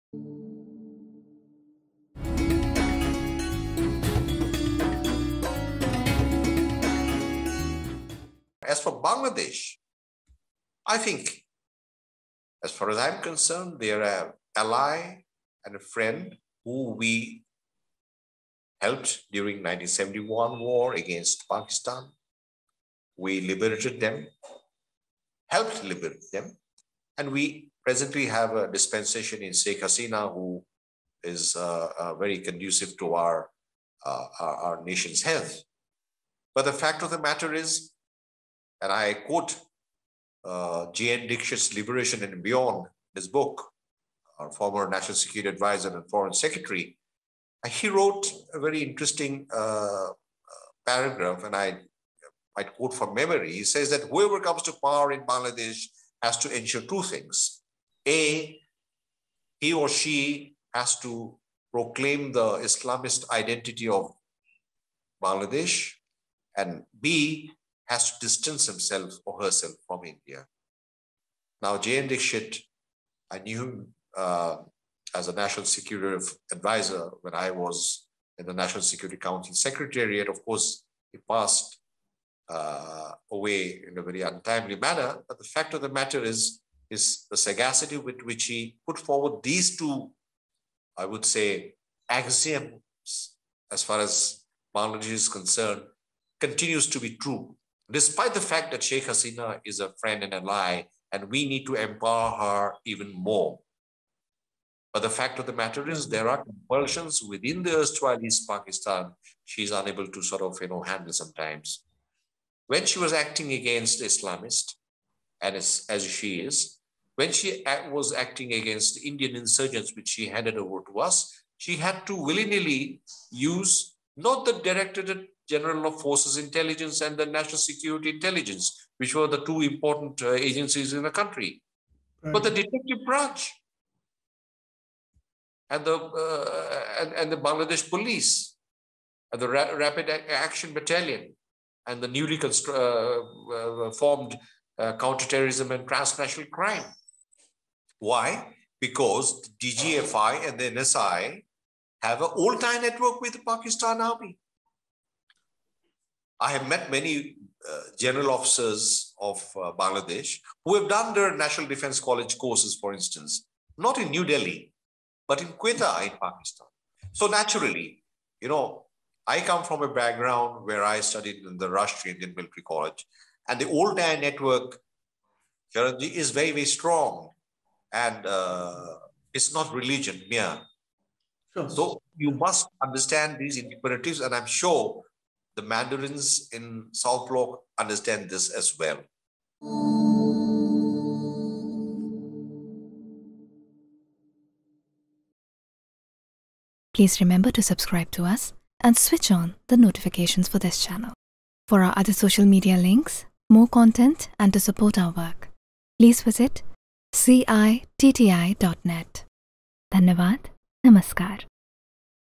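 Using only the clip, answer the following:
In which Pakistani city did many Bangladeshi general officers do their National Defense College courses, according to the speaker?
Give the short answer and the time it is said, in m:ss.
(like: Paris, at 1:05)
Quetta, at 2:45.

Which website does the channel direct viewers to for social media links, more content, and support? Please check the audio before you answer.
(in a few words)
citti.net.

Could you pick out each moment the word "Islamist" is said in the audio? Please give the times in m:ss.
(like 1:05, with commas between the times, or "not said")
1:02, 1:54.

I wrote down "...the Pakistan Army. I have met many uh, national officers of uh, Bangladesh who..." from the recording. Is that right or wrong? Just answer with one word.
wrong.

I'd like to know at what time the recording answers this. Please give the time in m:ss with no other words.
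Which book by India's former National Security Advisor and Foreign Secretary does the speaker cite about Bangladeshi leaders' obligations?
0:41.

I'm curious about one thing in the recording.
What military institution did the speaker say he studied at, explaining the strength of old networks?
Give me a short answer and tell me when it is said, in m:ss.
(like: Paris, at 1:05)
Rashtriya Indian Military College, at 2:51.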